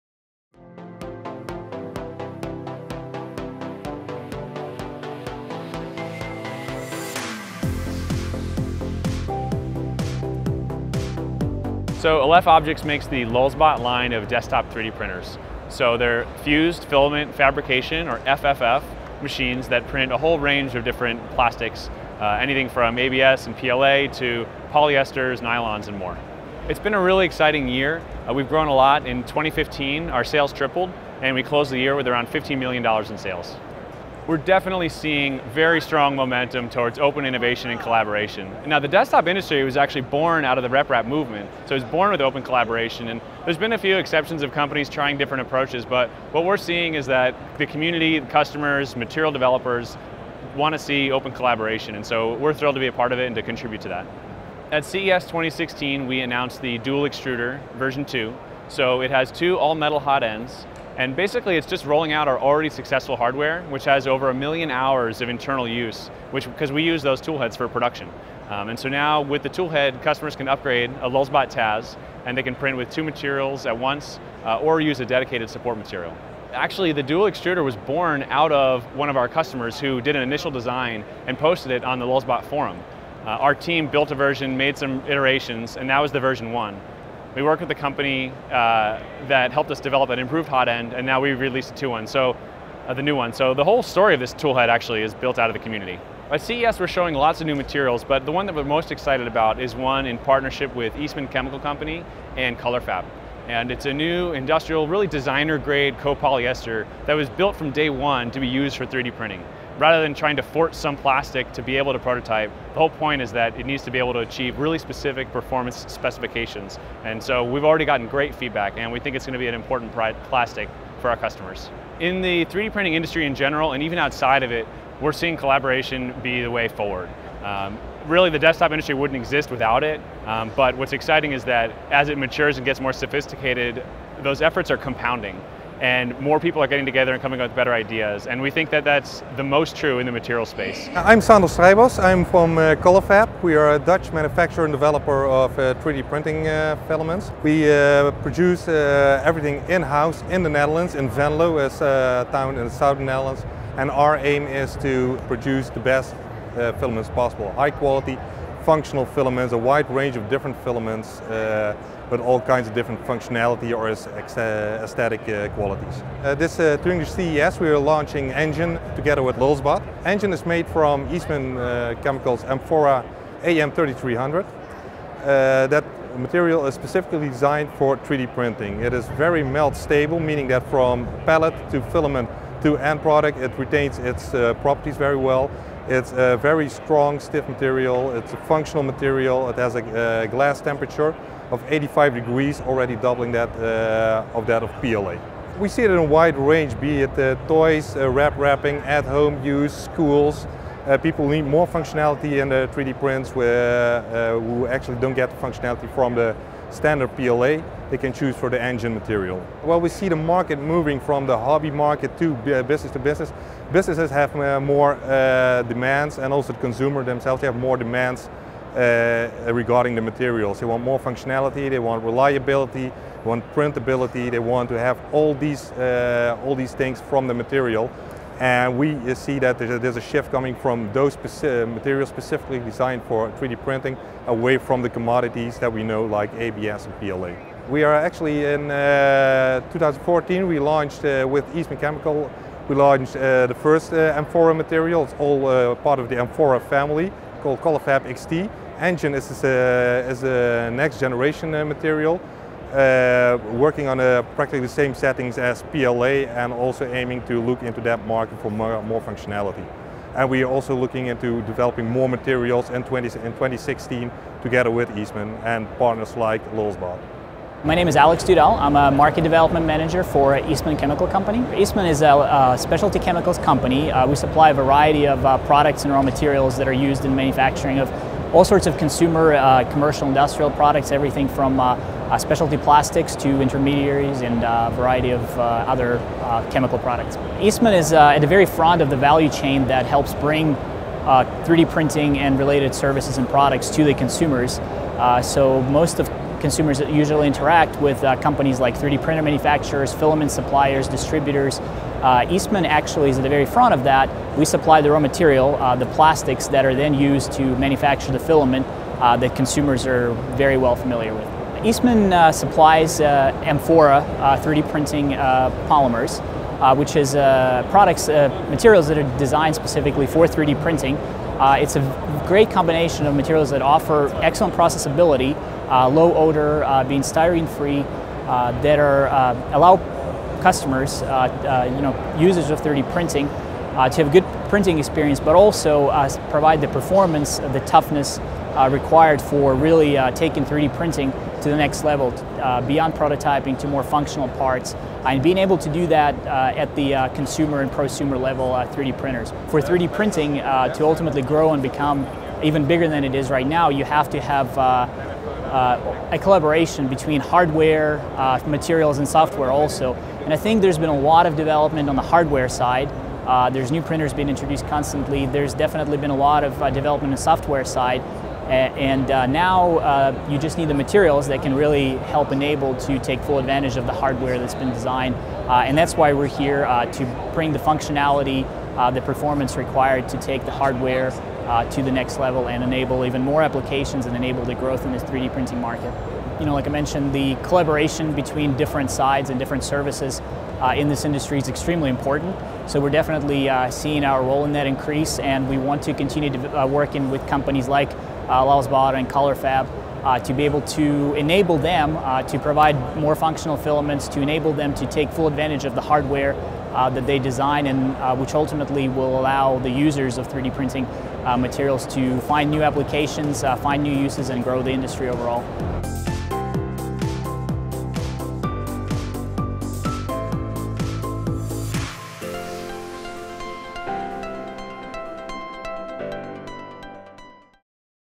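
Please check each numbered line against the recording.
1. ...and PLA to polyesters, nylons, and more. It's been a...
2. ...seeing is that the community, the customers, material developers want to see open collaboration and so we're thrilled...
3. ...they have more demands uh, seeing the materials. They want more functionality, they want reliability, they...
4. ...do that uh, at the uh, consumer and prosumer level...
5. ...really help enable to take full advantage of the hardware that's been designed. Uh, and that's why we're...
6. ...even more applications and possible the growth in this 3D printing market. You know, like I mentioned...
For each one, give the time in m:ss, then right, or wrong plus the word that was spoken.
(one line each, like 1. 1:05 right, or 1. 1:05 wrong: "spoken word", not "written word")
1. 0:23 right
2. 0:46 right
3. 3:37 wrong: "regarding", not "seeing"
4. 5:45 right
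5. 6:11 right
6. 6:23 wrong: "enable", not "possible".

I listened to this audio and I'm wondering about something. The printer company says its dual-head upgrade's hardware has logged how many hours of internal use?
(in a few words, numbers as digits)
over a million hours.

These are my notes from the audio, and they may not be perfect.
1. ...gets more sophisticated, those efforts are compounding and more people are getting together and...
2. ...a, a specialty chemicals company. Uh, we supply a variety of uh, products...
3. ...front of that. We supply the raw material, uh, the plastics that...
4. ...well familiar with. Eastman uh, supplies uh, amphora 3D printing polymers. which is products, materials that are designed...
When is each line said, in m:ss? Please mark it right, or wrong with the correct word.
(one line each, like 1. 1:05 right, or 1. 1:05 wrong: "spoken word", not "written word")
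1. 2:12 right
2. 4:32 right
3. 5:03 right
4. 5:10 right.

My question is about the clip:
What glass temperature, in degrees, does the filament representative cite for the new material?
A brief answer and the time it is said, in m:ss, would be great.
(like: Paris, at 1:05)
85, at 3:11.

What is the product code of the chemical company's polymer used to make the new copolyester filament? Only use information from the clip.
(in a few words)
AM3300.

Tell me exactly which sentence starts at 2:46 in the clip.
Uh, this during uh, the CES we are launching nGen together with Lulzbot.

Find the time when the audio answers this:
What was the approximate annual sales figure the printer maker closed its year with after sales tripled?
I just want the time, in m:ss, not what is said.
0:32.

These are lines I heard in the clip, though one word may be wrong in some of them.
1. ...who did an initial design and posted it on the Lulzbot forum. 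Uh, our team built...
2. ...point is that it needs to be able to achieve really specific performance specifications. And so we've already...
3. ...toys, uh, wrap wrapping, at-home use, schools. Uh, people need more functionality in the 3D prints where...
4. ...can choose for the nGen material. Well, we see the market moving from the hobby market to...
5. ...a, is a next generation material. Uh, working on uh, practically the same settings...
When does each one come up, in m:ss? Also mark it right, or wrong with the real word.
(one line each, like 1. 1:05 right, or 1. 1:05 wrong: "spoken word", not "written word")
1. 1:19 right
2. 1:52 right
3. 3:17 right
4. 3:27 right
5. 4:09 right.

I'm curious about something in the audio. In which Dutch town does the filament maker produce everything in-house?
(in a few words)
Venlo.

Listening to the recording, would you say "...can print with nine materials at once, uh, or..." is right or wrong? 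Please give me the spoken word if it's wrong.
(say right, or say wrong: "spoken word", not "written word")
wrong: "two", not "nine".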